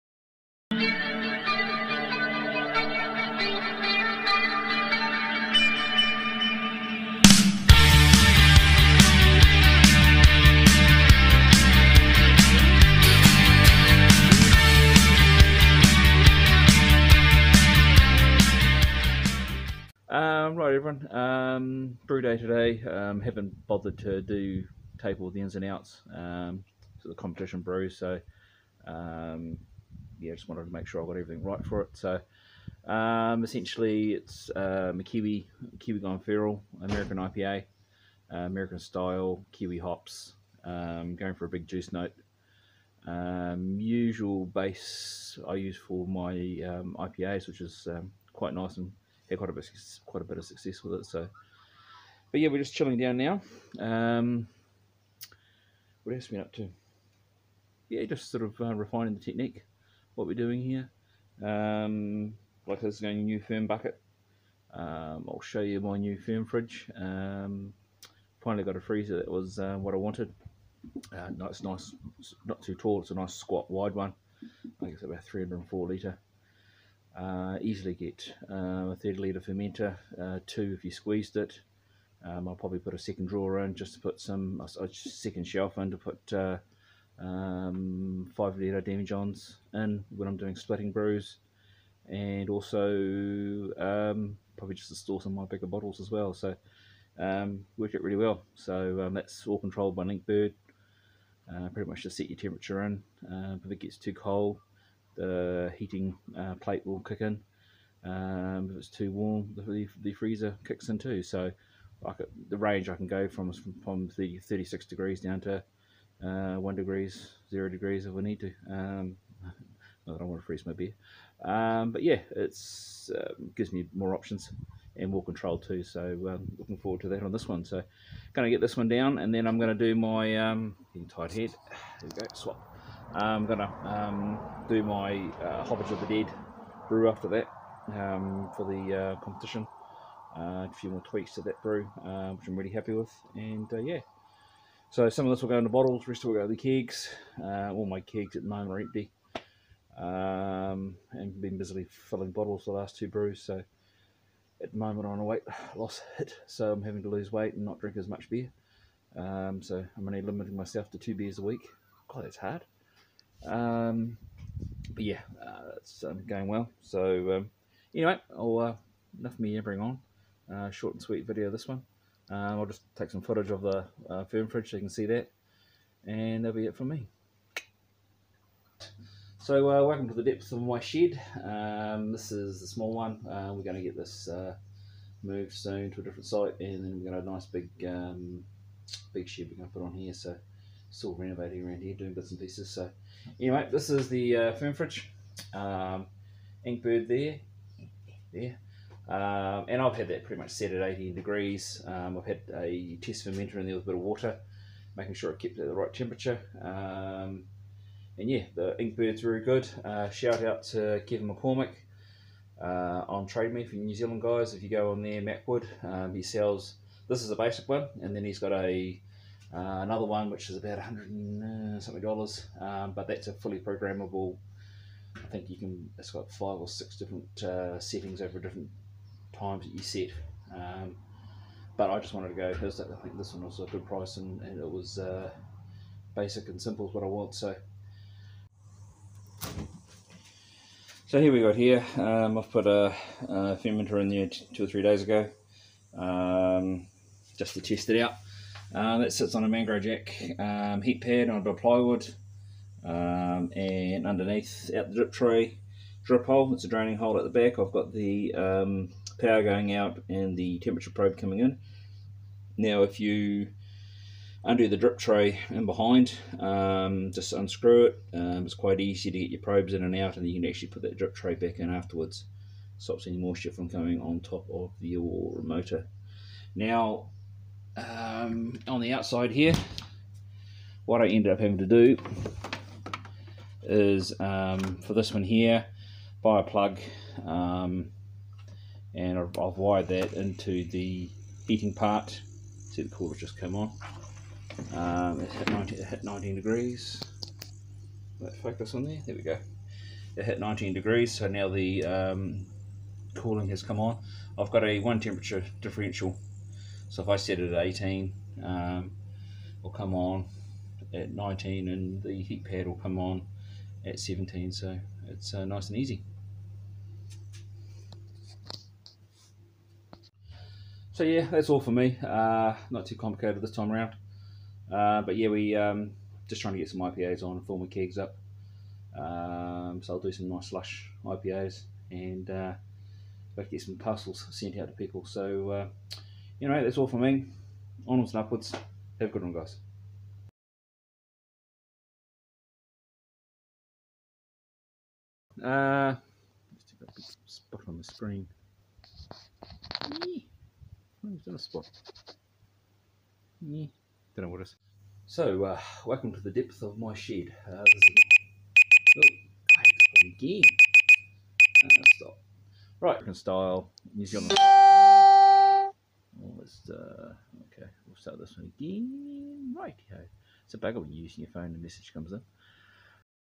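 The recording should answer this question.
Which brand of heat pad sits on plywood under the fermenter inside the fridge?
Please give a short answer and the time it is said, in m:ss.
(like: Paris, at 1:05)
Mangrove Jack, at 4:09.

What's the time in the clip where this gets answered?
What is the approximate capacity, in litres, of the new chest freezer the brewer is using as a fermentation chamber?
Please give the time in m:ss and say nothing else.
1:15.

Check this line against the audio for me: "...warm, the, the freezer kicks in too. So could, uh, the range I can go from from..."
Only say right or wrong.
right.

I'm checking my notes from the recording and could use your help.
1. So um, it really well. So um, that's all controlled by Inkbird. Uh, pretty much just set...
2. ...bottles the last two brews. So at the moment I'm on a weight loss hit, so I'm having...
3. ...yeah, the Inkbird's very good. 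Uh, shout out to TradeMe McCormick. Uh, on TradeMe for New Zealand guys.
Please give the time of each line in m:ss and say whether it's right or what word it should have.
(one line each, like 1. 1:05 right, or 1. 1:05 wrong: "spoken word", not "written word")
1. 1:36 right
2. 2:32 right
3. 3:28 wrong: "Kevin", not "TradeMe".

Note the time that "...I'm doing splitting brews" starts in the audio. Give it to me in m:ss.
1:30.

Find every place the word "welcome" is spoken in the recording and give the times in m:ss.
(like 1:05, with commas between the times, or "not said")
2:59, 5:55.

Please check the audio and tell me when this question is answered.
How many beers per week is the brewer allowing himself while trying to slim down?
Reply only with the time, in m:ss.
2:40.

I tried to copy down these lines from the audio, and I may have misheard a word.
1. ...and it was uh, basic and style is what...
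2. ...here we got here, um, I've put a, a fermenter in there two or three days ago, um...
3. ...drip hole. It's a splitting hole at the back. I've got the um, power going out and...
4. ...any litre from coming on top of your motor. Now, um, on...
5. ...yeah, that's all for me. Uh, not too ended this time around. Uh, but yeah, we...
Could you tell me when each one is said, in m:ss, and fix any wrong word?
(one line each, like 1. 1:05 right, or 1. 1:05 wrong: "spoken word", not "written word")
1. 3:54 wrong: "simple", not "style"
2. 4:01 right
3. 4:16 wrong: "draining", not "splitting"
4. 4:33 wrong: "moisture", not "litre"
5. 5:21 wrong: "complicated", not "ended".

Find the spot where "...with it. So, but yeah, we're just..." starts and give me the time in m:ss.
0:50.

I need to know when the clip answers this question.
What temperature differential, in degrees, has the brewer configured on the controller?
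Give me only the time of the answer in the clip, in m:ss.
5:04.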